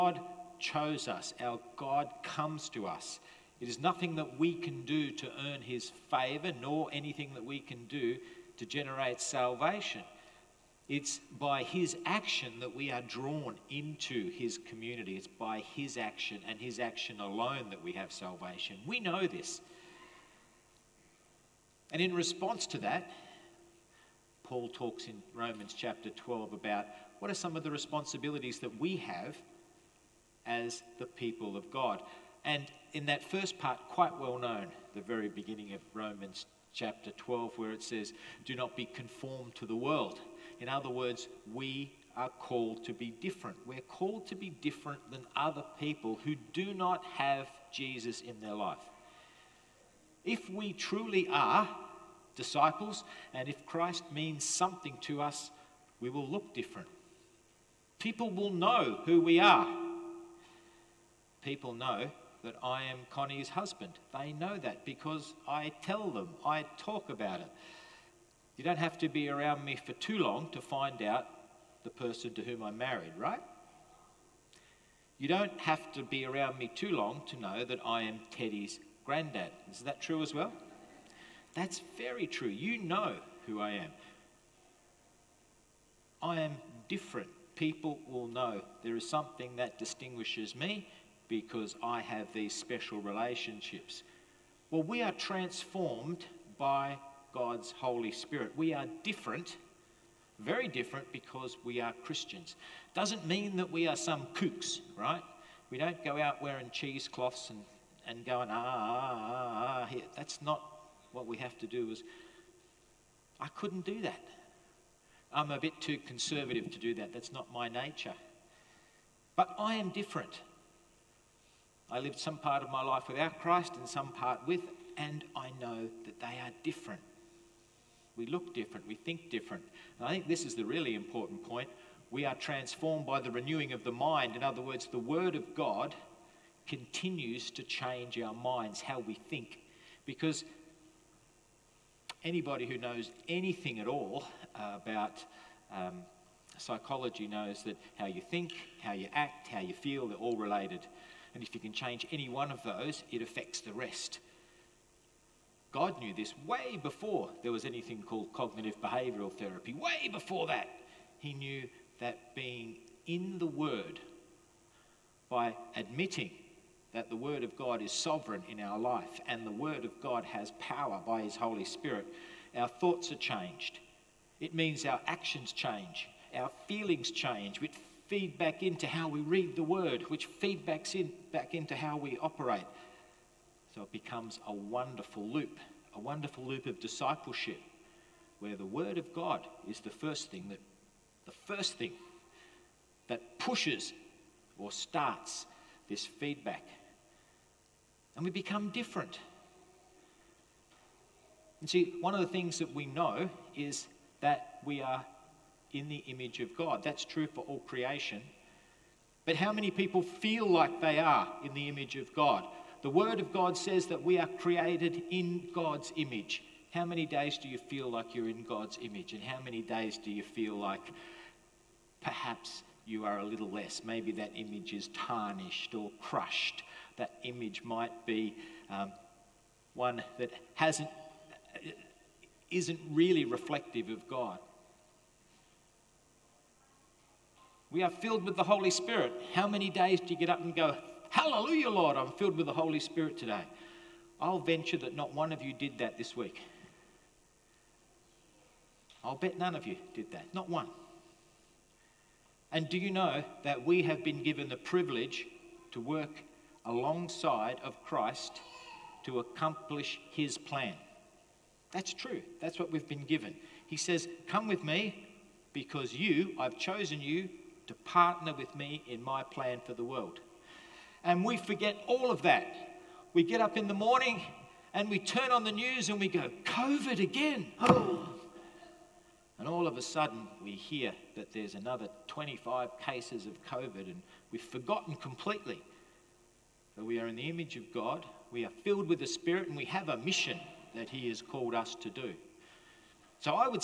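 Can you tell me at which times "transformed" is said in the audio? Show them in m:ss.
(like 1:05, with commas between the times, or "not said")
1:35, 2:12.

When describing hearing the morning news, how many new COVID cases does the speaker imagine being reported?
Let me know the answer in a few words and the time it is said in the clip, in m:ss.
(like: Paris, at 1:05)
25, at 4:42.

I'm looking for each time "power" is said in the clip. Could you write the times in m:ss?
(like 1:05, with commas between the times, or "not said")
2:50.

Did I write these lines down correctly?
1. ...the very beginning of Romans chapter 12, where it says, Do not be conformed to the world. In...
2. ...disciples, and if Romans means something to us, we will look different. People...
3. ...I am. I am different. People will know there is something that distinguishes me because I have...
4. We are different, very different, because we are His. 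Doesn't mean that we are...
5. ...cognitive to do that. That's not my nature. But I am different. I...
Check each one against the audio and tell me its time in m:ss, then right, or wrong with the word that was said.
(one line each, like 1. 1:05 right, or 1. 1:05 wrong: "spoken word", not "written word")
1. 0:34 right
2. 0:52 wrong: "Christ", not "Romans"
3. 1:23 right
4. 1:38 wrong: "Christians", not "His"
5. 1:55 wrong: "conservative", not "cognitive".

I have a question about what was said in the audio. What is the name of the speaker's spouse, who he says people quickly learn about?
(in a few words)
Connie.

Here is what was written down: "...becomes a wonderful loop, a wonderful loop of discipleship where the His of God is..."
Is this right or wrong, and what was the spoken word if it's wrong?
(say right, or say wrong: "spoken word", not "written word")
wrong: "Word", not "His".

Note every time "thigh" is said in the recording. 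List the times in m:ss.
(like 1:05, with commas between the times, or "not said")
not said.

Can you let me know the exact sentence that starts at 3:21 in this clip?
And see, one of the things that we know is that we are in the image of God.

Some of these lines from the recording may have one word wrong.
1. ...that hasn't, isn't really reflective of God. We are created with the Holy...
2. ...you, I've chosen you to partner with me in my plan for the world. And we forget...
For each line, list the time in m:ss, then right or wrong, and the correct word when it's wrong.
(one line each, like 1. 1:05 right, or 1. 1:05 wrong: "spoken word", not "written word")
1. 3:50 wrong: "filled", not "created"
2. 4:25 right.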